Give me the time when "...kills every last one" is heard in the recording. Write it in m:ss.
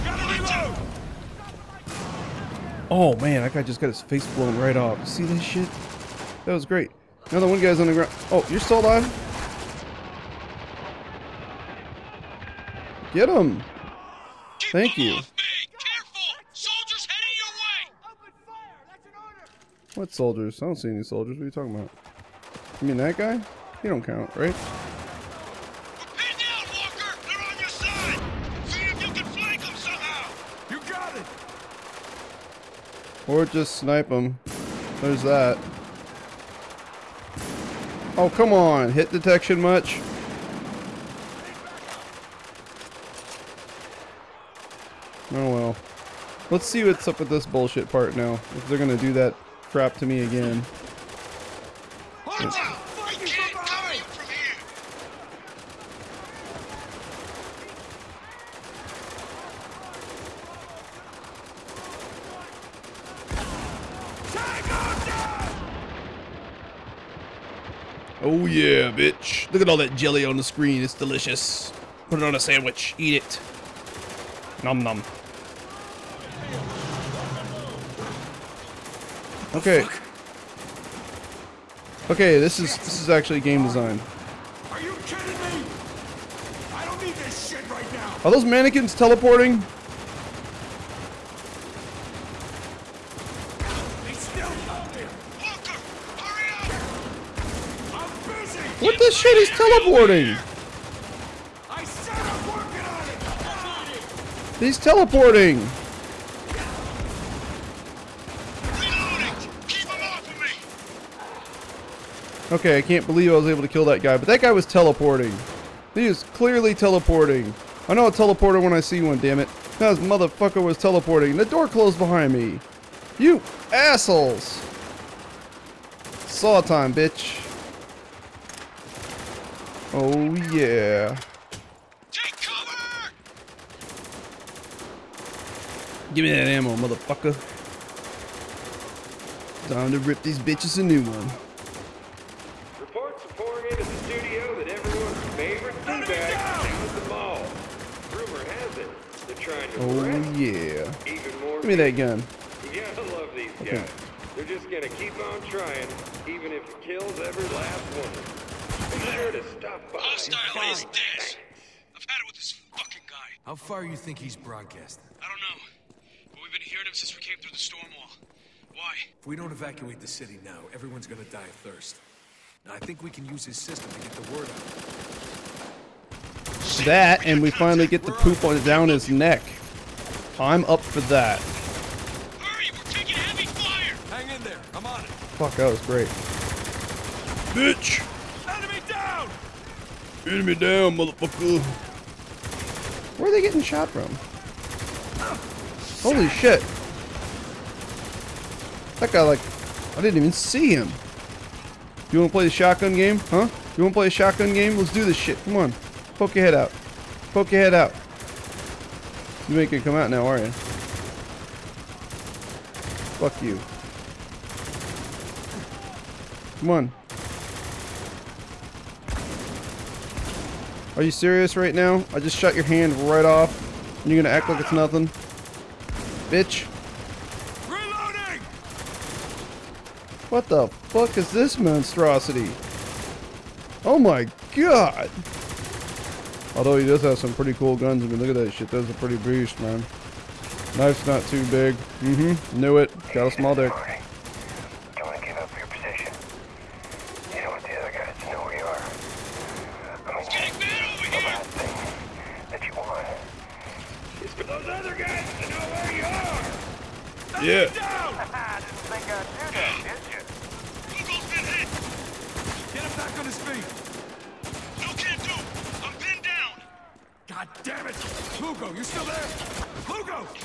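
2:36.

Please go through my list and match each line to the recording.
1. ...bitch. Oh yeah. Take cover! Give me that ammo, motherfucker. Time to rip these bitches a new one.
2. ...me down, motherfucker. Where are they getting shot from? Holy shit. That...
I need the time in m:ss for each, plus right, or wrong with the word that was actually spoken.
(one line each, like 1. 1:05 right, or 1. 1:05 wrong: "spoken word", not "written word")
1. 2:06 right
2. 3:10 right.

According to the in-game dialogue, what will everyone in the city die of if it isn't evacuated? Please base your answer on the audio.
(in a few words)
thirst.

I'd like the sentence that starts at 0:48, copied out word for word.
If they're gonna do that crap to me again.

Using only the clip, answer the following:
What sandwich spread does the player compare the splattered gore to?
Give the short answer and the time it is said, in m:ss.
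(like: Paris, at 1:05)
jelly, at 1:09.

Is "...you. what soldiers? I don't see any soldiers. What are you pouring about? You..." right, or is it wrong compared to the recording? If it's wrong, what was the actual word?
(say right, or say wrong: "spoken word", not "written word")
wrong: "talking", not "pouring".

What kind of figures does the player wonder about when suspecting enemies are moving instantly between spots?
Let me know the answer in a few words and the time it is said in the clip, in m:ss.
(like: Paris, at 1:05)
mannequins, at 1:28.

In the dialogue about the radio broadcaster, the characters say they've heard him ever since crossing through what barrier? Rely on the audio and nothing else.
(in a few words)
storm wall.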